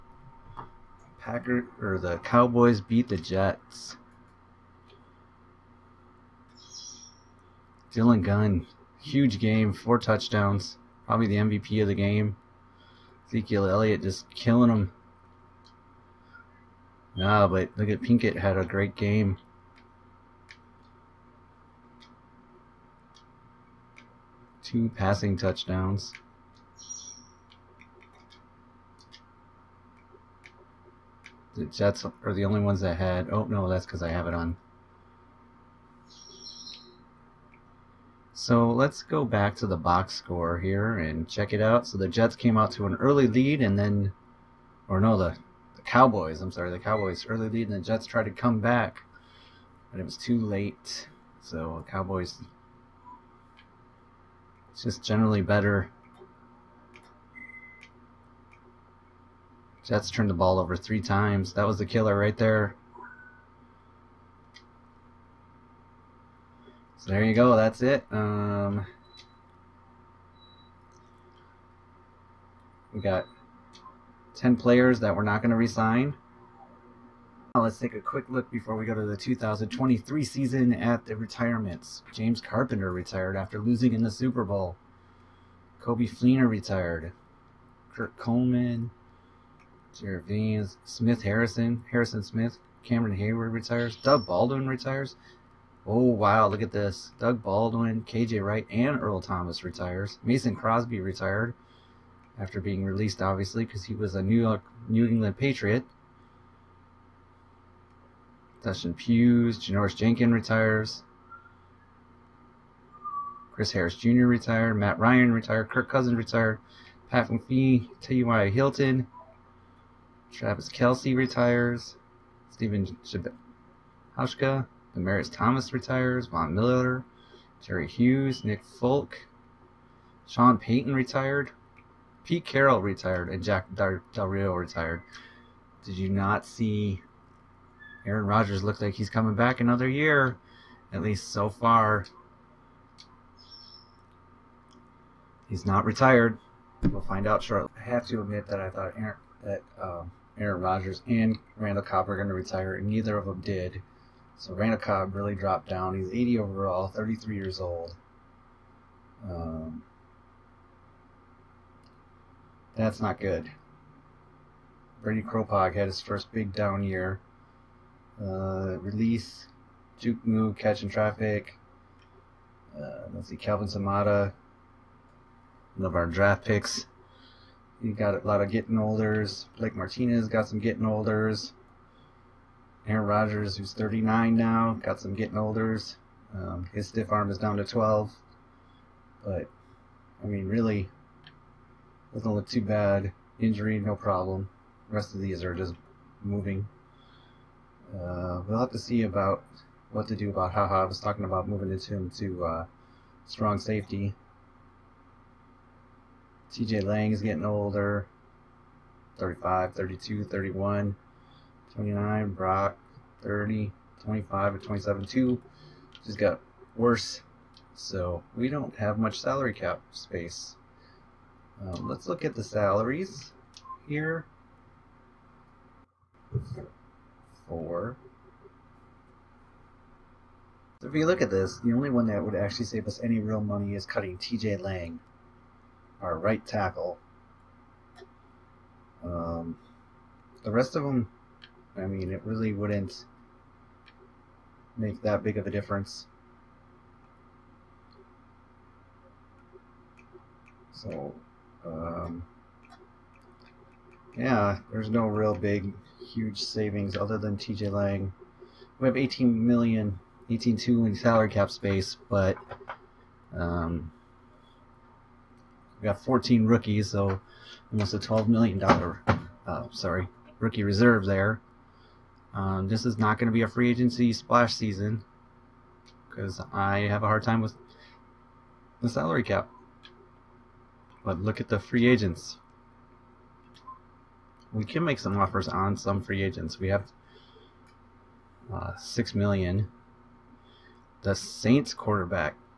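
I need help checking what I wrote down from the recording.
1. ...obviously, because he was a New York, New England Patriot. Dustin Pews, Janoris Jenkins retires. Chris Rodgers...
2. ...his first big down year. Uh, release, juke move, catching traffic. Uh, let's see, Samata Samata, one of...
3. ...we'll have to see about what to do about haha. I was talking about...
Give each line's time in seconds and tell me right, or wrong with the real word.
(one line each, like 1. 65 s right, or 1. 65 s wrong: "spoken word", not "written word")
1. 103 s wrong: "Harris", not "Rodgers"
2. 165 s wrong: "Calvin", not "Samata"
3. 198 s right.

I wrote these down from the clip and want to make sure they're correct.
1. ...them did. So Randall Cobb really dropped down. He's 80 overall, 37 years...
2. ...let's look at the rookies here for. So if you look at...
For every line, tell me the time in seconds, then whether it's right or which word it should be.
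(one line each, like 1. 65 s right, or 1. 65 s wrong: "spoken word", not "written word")
1. 153 s wrong: "33", not "37"
2. 221 s wrong: "salaries", not "rookies".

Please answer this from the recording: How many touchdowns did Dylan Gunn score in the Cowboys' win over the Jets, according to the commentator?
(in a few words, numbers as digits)
4.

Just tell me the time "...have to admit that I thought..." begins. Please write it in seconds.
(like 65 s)
147 s.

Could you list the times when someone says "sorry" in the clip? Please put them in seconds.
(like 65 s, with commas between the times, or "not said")
46 s, 269 s.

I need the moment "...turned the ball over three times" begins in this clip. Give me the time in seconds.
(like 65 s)
60 s.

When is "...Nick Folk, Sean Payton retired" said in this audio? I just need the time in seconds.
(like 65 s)
128 s.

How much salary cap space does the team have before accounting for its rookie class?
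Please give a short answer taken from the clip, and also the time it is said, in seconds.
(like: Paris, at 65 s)
18.2 million, at 260 s.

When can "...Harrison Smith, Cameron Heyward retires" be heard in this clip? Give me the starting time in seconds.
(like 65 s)
91 s.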